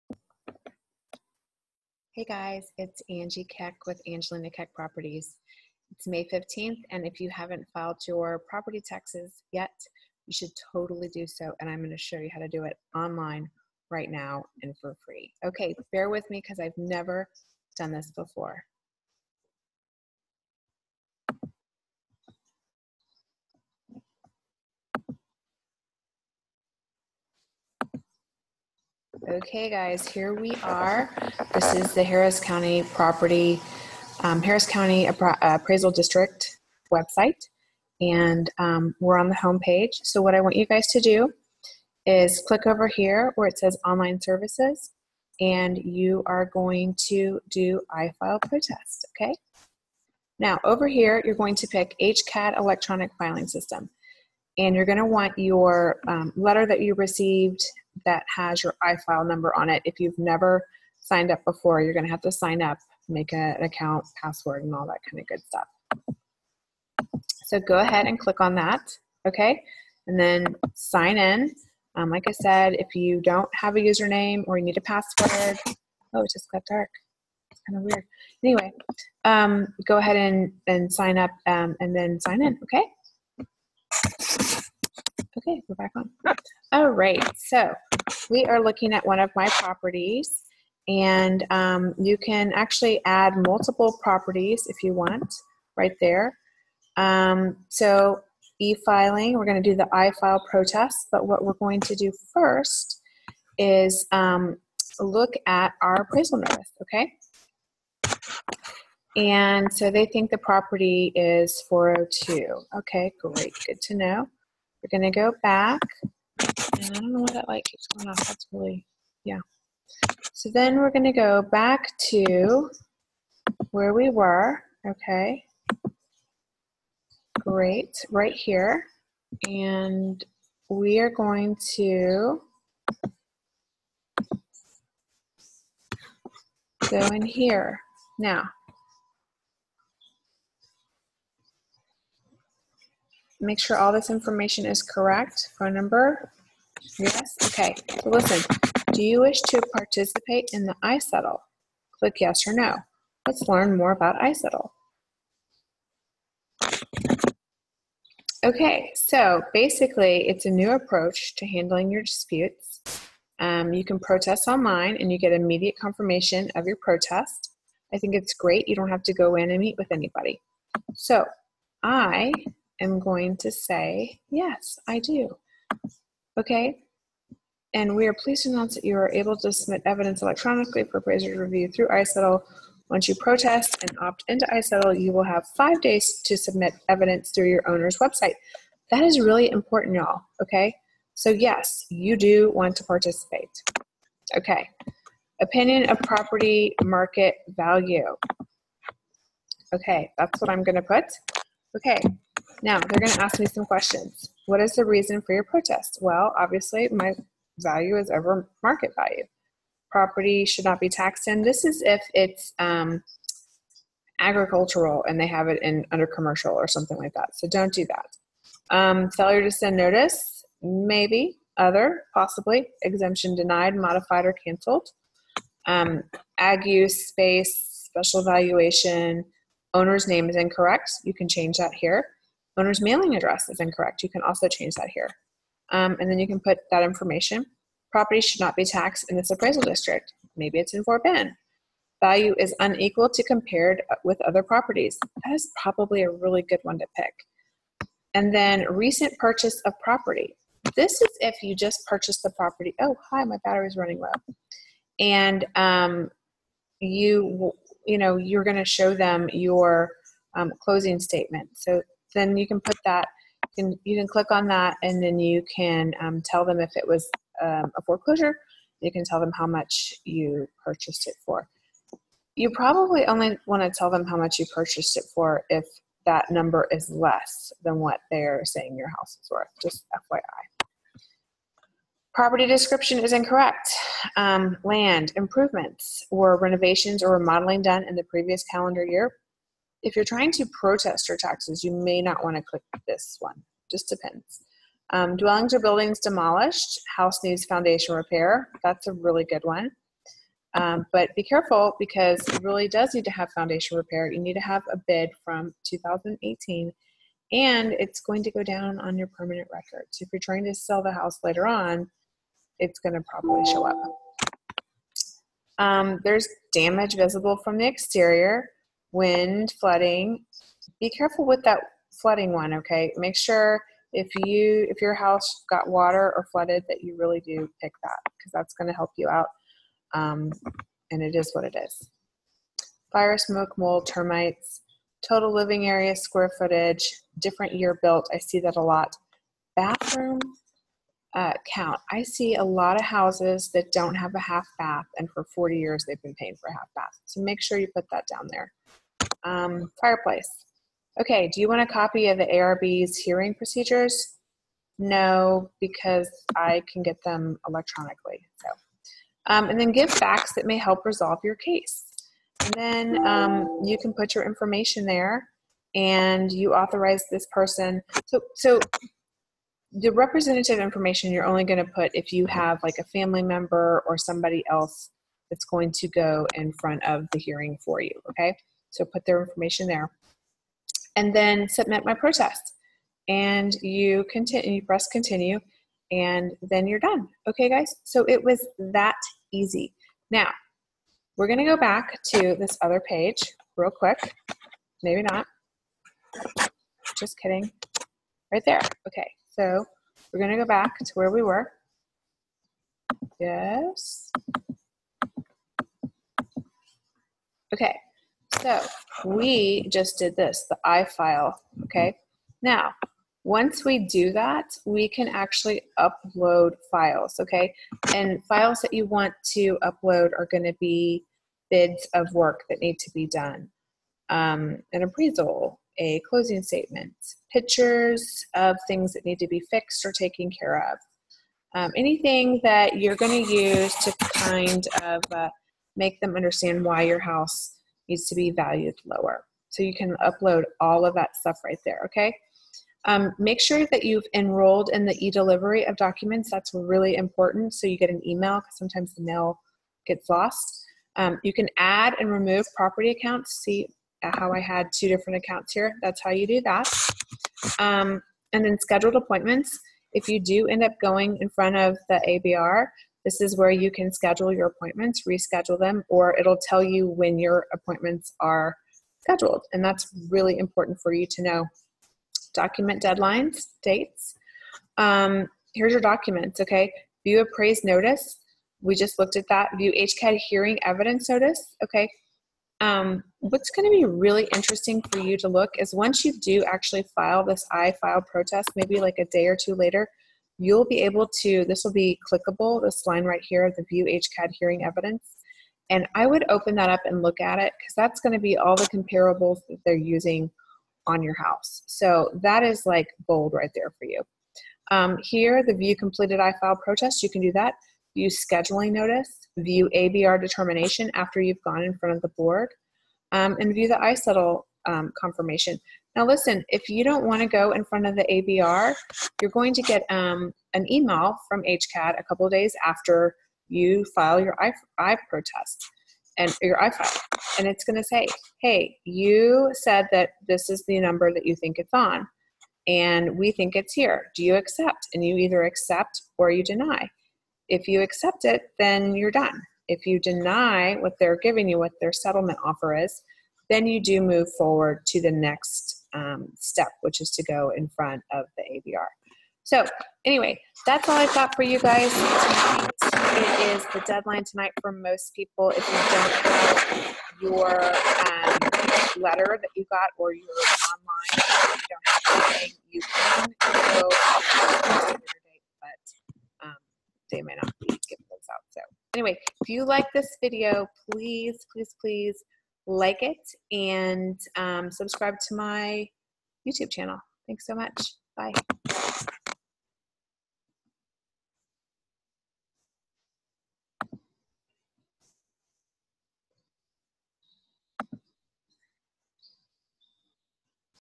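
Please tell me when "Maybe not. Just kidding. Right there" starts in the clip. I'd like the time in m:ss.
6:34.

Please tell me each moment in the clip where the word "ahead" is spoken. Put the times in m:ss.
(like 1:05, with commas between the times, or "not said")
1:07, 1:19.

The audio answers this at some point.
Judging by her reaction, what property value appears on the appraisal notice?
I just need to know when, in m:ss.
1:51.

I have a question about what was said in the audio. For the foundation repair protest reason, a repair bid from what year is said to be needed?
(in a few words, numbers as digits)
2018.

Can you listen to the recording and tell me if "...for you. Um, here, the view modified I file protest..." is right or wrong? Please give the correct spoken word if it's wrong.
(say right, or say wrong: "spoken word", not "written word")
wrong: "completed", not "modified".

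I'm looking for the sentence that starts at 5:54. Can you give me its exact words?
No, because I can get them electronically.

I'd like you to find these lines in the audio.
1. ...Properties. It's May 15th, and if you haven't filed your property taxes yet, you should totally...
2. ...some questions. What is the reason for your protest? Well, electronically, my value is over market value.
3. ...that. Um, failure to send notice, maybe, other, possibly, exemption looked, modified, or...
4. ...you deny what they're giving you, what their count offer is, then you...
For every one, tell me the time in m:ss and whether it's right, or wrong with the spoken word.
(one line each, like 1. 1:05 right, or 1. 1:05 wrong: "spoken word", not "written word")
1. 0:04 right
2. 3:23 wrong: "obviously", not "electronically"
3. 3:37 wrong: "denied", not "looked"
4. 8:59 wrong: "settlement", not "count".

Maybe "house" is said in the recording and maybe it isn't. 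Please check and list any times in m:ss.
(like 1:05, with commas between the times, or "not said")
4:38, 4:56, 5:10, 5:24, 5:42, 7:16, 8:21.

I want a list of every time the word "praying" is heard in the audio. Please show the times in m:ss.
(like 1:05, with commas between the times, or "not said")
not said.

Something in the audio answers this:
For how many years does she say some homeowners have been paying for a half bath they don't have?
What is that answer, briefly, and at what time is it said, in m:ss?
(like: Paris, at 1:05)
40, at 5:45.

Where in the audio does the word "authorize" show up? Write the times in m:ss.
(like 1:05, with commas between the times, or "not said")
6:06.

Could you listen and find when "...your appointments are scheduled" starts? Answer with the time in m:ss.
7:47.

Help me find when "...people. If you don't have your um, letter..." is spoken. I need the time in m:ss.
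9:15.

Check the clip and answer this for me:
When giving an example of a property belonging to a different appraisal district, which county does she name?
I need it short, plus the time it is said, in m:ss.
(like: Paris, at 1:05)
Fort Bend, at 4:00.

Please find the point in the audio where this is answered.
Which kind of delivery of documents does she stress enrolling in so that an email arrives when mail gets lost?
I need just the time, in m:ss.
7:25.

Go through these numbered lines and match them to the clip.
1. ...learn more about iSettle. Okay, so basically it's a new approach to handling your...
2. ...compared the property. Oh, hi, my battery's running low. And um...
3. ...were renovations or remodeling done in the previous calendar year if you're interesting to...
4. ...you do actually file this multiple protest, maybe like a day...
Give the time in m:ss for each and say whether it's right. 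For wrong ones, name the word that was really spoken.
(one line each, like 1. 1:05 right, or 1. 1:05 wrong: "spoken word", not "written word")
1. 2:33 right
2. 4:11 wrong: "purchased", not "compared"
3. 4:46 wrong: "trying", not "interesting"
4. 8:06 wrong: "iFile", not "multiple".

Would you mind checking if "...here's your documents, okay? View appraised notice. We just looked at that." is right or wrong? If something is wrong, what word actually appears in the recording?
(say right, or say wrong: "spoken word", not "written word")
right.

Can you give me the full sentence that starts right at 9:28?
So anyway, if you like this video, please, please, please like it and um, subscribe to my YouTube channel.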